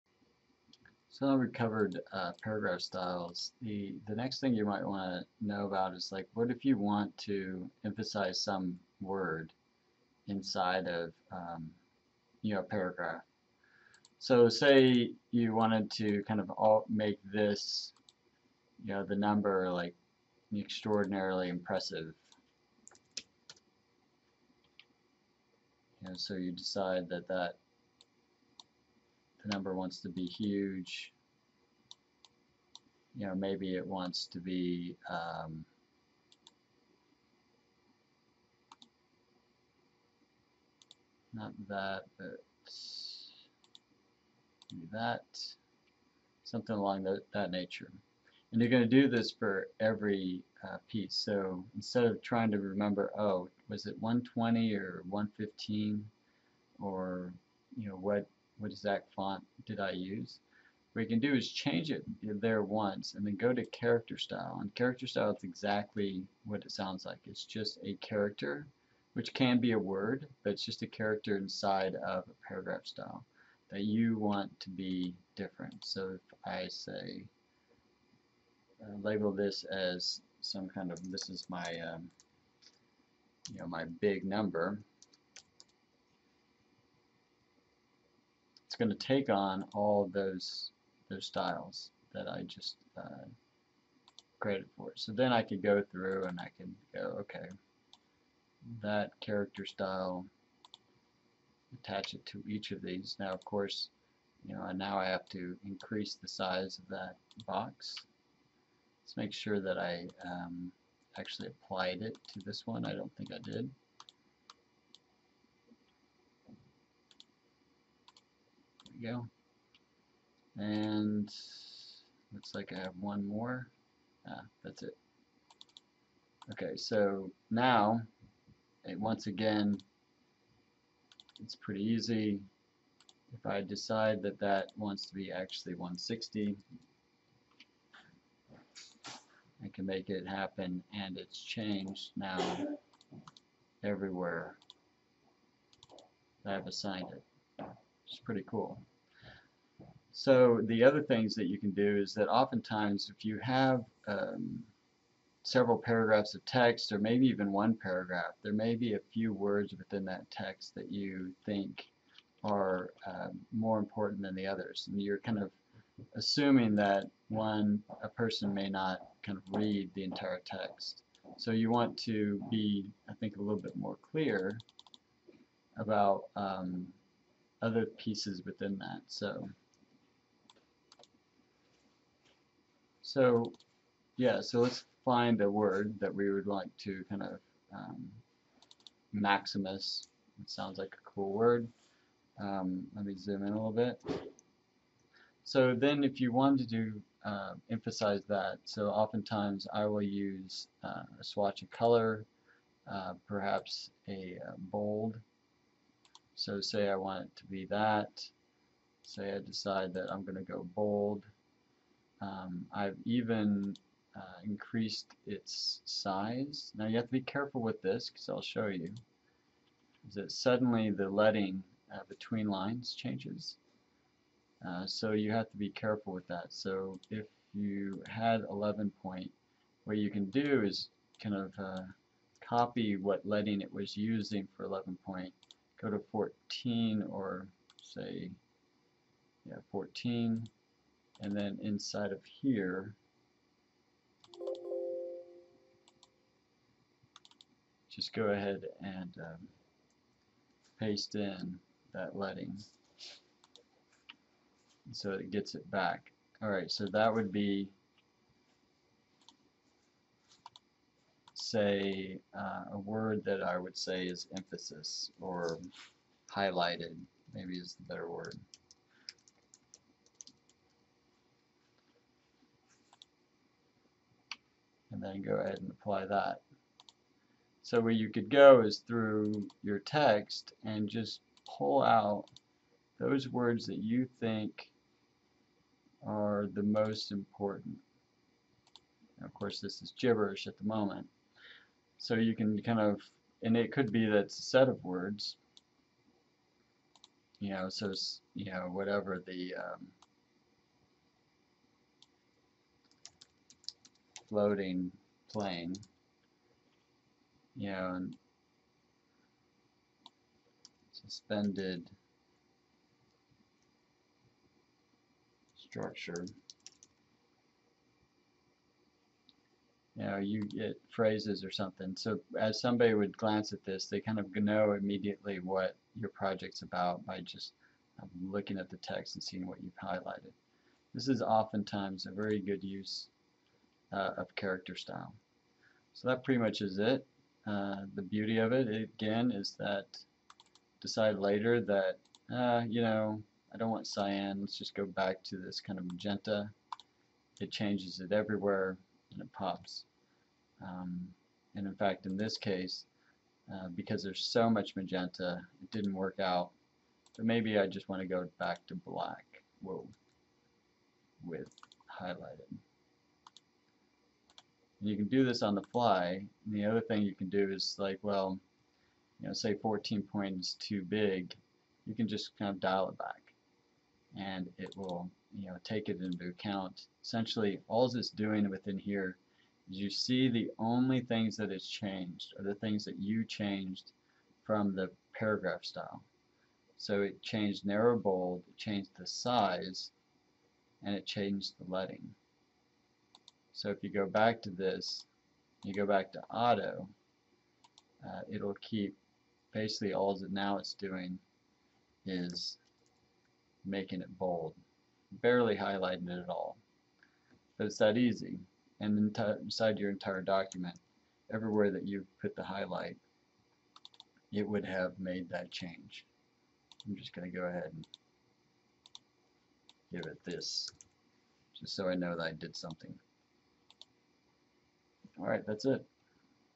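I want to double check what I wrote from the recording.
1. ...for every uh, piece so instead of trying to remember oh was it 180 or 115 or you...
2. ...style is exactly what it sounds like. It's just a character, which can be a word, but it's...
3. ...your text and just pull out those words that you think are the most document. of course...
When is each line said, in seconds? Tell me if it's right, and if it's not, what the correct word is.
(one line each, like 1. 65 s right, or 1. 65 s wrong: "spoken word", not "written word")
1. 49 s wrong: "120", not "180"
2. 65 s right
3. 279 s wrong: "important", not "document".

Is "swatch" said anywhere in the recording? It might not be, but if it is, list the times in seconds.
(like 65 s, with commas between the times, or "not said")
201 s.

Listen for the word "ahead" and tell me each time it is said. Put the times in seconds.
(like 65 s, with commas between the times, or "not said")
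248 s, 275 s, 417 s.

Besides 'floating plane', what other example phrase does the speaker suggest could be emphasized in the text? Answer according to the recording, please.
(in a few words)
suspended structure.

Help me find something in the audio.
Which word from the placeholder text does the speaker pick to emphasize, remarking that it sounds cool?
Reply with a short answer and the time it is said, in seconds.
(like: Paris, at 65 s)
maximus, at 189 s.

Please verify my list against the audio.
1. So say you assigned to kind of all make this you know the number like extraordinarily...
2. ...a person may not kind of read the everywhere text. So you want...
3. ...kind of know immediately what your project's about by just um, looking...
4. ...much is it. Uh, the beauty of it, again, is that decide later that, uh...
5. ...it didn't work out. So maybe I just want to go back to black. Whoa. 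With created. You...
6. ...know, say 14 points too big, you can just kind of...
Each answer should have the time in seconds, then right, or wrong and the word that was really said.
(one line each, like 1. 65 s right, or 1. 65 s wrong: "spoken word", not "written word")
1. 14 s wrong: "wanted", not "assigned"
2. 168 s wrong: "entire", not "everywhere"
3. 323 s right
4. 336 s right
5. 355 s wrong: "highlighted", not "created"
6. 369 s right.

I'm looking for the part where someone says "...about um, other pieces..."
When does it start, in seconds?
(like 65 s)
175 s.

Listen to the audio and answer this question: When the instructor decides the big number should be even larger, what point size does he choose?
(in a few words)
160.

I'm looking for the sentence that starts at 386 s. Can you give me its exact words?
So it changed narrow bold, it changed the size, and it changed the leading.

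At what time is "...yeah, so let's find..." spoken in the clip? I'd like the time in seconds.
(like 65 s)
184 s.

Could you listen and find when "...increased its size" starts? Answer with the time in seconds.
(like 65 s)
214 s.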